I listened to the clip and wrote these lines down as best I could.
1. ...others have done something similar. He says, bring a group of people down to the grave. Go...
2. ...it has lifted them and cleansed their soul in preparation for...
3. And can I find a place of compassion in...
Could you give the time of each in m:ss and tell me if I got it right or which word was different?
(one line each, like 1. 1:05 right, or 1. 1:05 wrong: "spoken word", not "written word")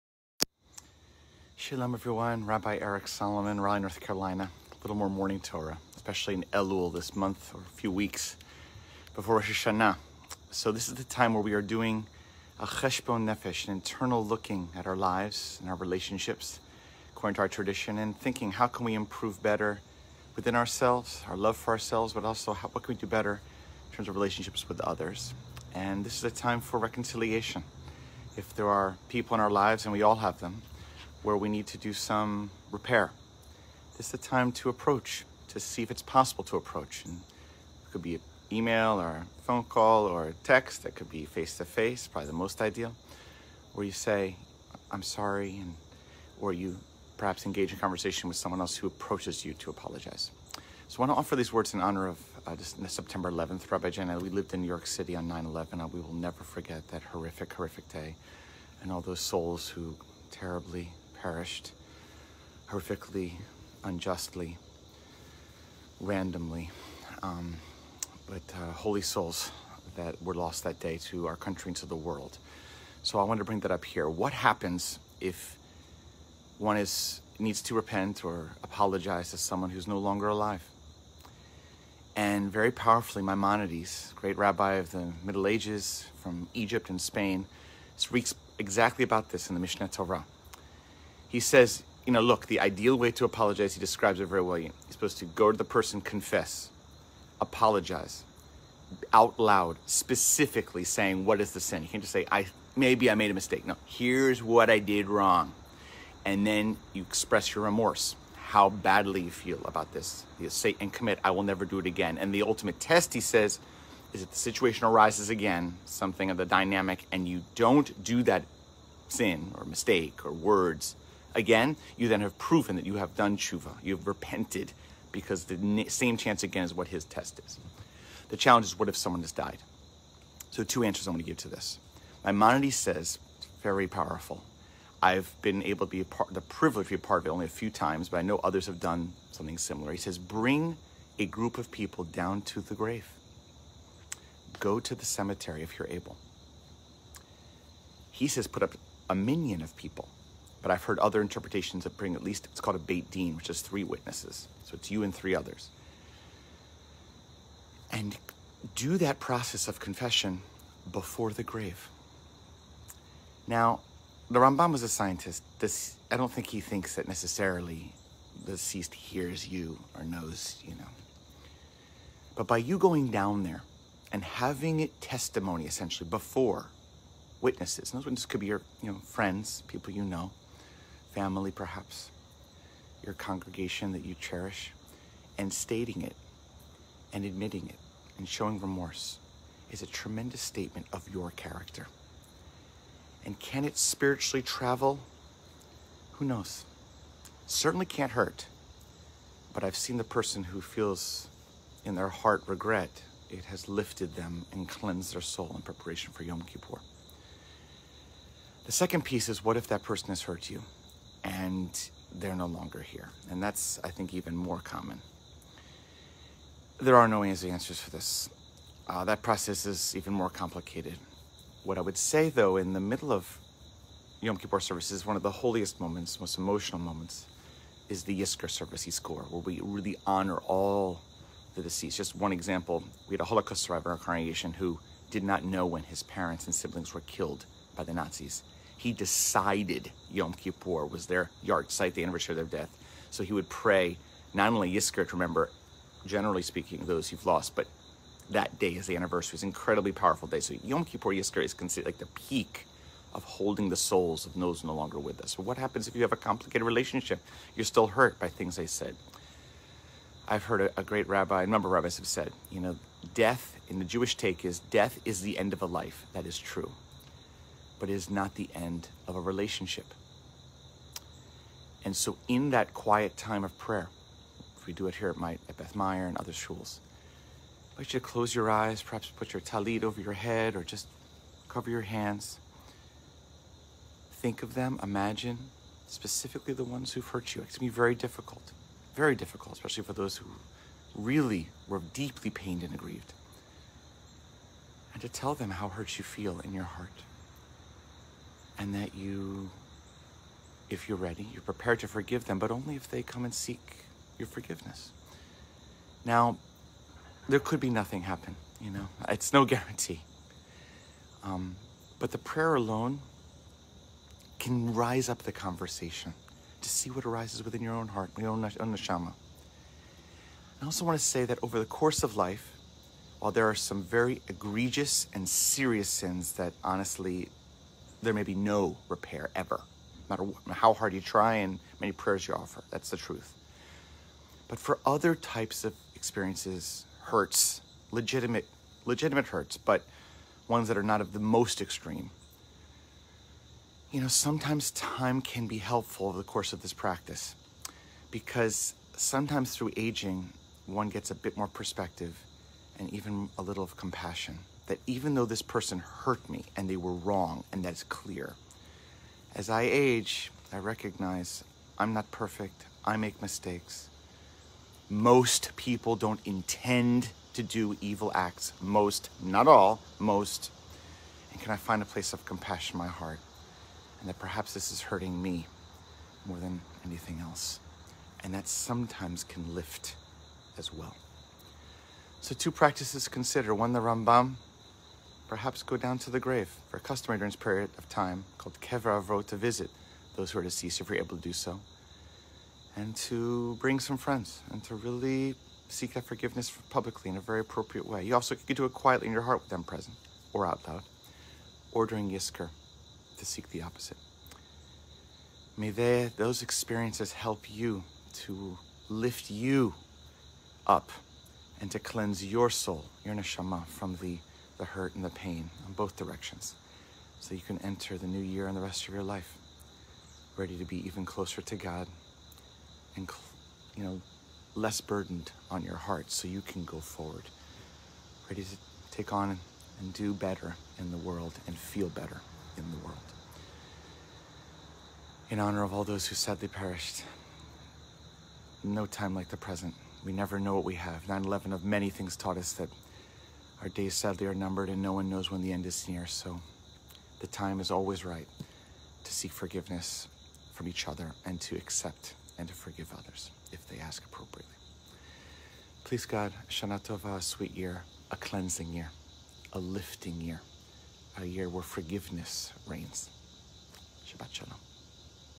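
1. 2:18 right
2. 3:23 right
3. 6:11 right.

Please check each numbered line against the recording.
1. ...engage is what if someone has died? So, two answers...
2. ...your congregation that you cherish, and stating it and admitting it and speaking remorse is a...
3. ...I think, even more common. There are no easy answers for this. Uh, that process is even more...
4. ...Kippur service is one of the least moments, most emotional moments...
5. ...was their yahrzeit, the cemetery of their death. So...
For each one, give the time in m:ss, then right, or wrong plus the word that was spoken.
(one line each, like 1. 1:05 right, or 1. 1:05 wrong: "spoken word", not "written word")
1. 2:08 wrong: "challenge", not "engage"
2. 3:03 wrong: "showing", not "speaking"
3. 3:33 right
4. 3:44 wrong: "holiest", not "least"
5. 4:00 wrong: "anniversary", not "cemetery".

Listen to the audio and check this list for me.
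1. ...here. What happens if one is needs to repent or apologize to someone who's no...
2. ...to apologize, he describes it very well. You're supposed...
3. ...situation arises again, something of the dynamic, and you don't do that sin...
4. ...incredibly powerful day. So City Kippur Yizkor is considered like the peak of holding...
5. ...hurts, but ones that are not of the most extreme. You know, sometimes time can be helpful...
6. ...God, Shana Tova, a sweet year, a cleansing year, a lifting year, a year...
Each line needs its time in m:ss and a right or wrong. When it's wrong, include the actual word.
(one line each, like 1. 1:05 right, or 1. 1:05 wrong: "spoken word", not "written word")
1. 1:13 right
2. 1:33 right
3. 1:54 right
4. 4:09 wrong: "Yom", not "City"
5. 5:39 right
6. 7:36 right.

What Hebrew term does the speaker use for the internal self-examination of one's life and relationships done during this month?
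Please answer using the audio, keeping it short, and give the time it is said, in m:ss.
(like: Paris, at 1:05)
cheshbon nefesh, at 0:12.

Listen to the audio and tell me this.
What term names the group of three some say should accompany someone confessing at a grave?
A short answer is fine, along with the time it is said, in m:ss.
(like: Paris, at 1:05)
Beit Din, at 2:32.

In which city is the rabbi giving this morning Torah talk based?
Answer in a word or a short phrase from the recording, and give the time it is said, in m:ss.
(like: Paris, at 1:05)
Raleigh, North Carolina, at 0:03.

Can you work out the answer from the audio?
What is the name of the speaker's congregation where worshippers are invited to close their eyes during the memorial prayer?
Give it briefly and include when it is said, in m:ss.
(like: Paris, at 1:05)
Beth Meyer, at 4:35.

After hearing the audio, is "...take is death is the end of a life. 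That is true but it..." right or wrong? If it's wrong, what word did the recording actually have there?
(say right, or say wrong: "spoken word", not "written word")
right.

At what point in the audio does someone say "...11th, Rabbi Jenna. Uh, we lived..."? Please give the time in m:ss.
0:53.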